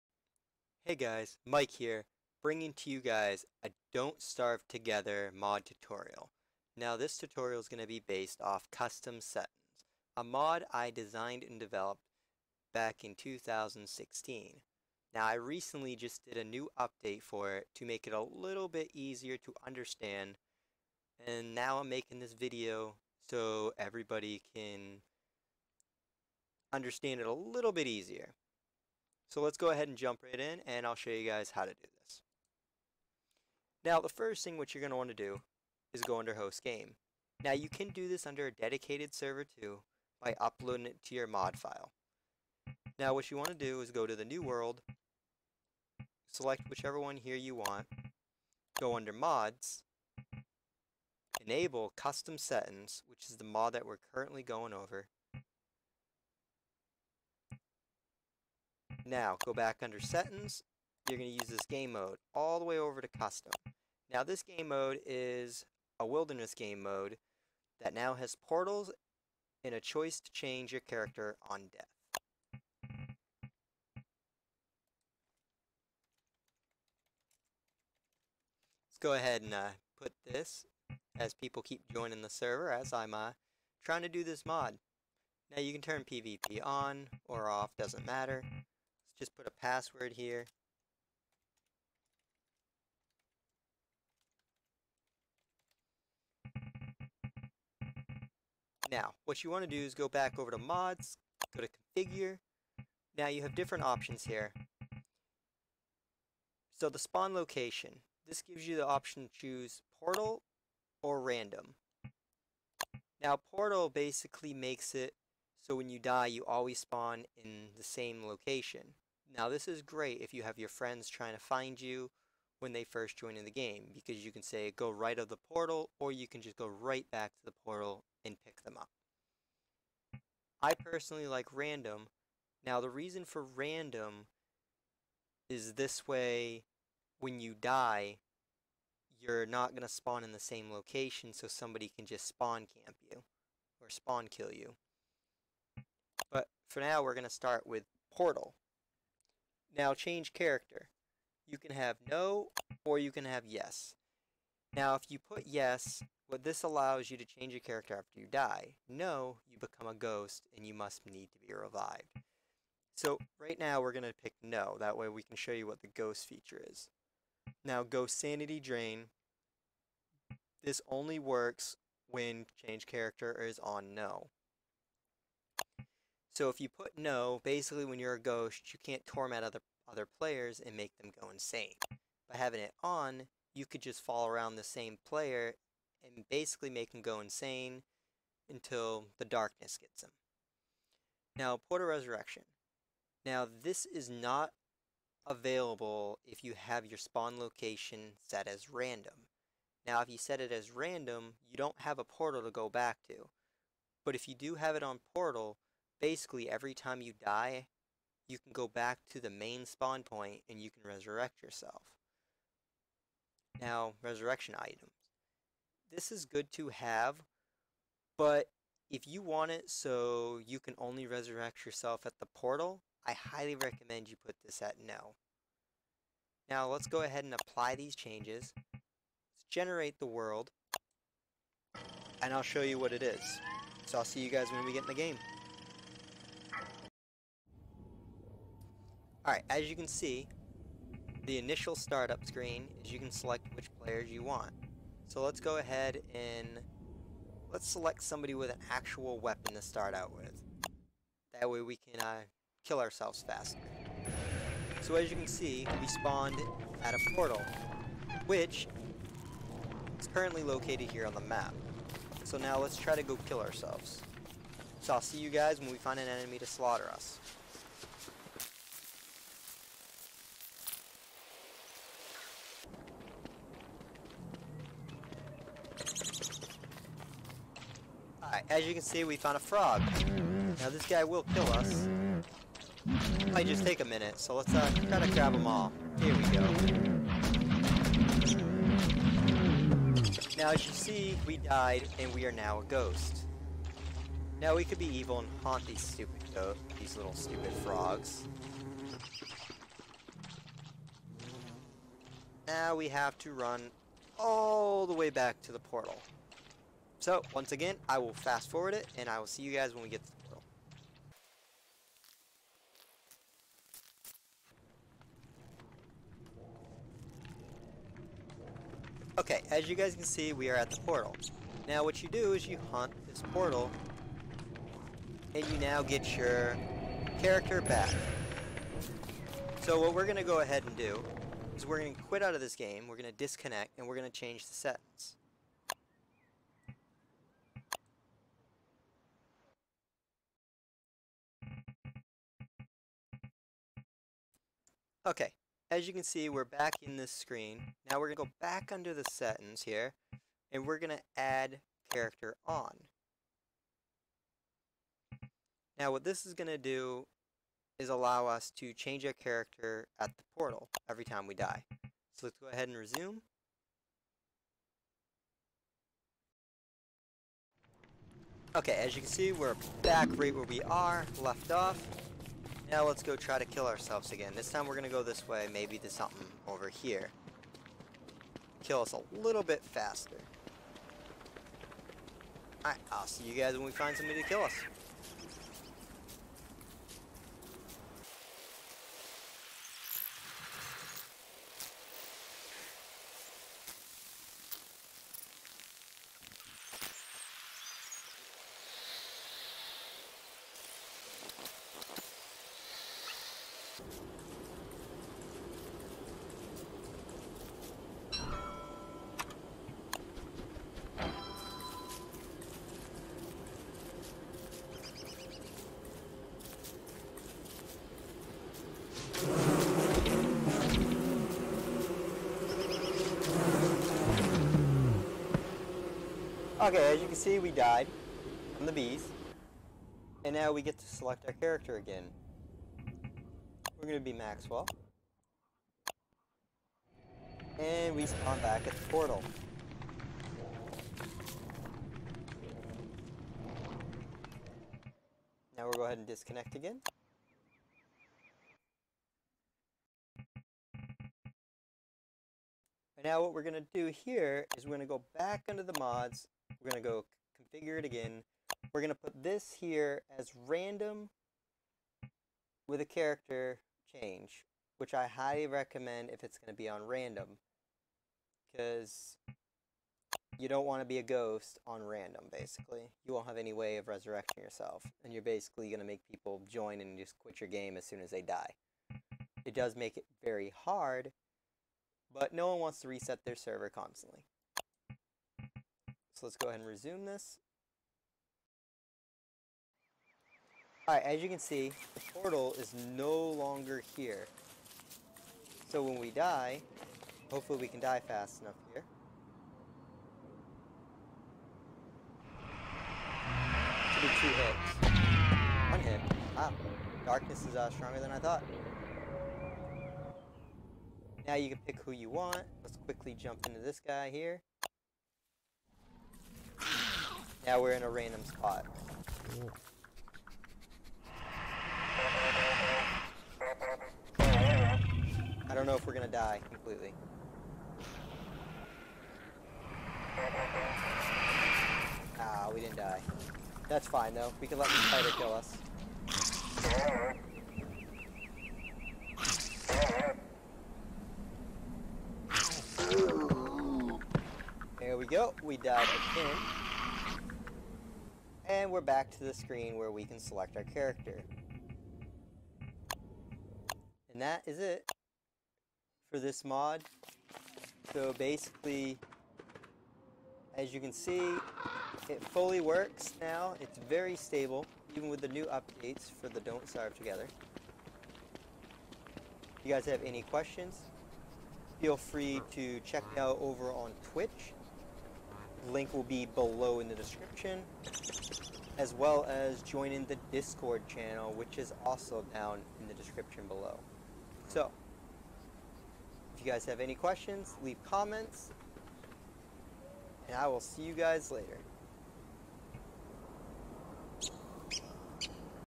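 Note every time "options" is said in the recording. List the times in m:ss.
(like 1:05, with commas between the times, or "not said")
1:43, 1:48.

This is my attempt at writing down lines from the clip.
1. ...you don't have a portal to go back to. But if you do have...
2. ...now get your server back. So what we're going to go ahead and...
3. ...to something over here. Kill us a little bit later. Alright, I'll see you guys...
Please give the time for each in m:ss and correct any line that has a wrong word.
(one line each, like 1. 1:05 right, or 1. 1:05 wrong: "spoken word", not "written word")
1. 3:21 right
2. 5:25 wrong: "character", not "server"
3. 6:15 wrong: "faster", not "later".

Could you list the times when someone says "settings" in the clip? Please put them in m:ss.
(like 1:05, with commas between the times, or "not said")
0:09, 0:52, 0:59, 5:34, 5:49.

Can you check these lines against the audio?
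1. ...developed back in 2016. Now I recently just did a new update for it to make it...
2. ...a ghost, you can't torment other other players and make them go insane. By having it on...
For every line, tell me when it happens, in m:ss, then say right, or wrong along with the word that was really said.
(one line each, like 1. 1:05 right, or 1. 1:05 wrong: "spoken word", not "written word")
1. 0:11 right
2. 2:58 right.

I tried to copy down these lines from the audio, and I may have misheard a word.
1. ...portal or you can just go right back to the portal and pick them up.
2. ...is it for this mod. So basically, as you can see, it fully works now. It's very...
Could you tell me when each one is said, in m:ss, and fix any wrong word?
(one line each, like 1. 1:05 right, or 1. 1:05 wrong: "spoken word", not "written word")
1. 2:05 right
2. 9:14 right.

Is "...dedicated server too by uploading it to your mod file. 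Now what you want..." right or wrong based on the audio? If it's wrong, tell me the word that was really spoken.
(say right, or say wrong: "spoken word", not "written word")
right.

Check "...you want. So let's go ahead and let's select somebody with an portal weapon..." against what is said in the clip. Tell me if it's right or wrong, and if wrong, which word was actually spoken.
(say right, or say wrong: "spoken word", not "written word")
wrong: "actual", not "portal".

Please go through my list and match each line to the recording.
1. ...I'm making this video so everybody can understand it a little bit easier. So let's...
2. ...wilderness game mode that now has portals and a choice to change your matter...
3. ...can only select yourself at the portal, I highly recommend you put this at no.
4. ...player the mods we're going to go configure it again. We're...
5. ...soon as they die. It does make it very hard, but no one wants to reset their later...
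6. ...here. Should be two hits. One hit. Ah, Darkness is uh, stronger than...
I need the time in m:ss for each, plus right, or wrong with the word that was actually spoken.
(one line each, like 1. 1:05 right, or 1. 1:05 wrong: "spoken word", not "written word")
1. 0:21 right
2. 1:06 wrong: "character", not "matter"
3. 3:40 wrong: "resurrect", not "select"
4. 7:35 wrong: "under", not "player"
5. 7:57 wrong: "server", not "later"
6. 8:18 right.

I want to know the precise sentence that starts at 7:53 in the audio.
You won't have any way of resurrecting yourself.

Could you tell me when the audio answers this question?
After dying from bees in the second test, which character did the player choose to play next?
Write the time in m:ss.
7:14.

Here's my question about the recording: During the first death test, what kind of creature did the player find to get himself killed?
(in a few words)
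frog.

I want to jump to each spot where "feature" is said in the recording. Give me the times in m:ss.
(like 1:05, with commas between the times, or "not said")
2:46.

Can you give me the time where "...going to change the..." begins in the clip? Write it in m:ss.
5:33.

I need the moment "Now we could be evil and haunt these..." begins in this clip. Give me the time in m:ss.
4:54.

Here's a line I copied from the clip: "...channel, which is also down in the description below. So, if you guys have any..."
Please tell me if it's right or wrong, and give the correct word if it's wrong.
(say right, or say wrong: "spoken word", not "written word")
right.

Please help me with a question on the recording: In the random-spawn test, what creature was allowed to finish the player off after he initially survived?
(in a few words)
spider.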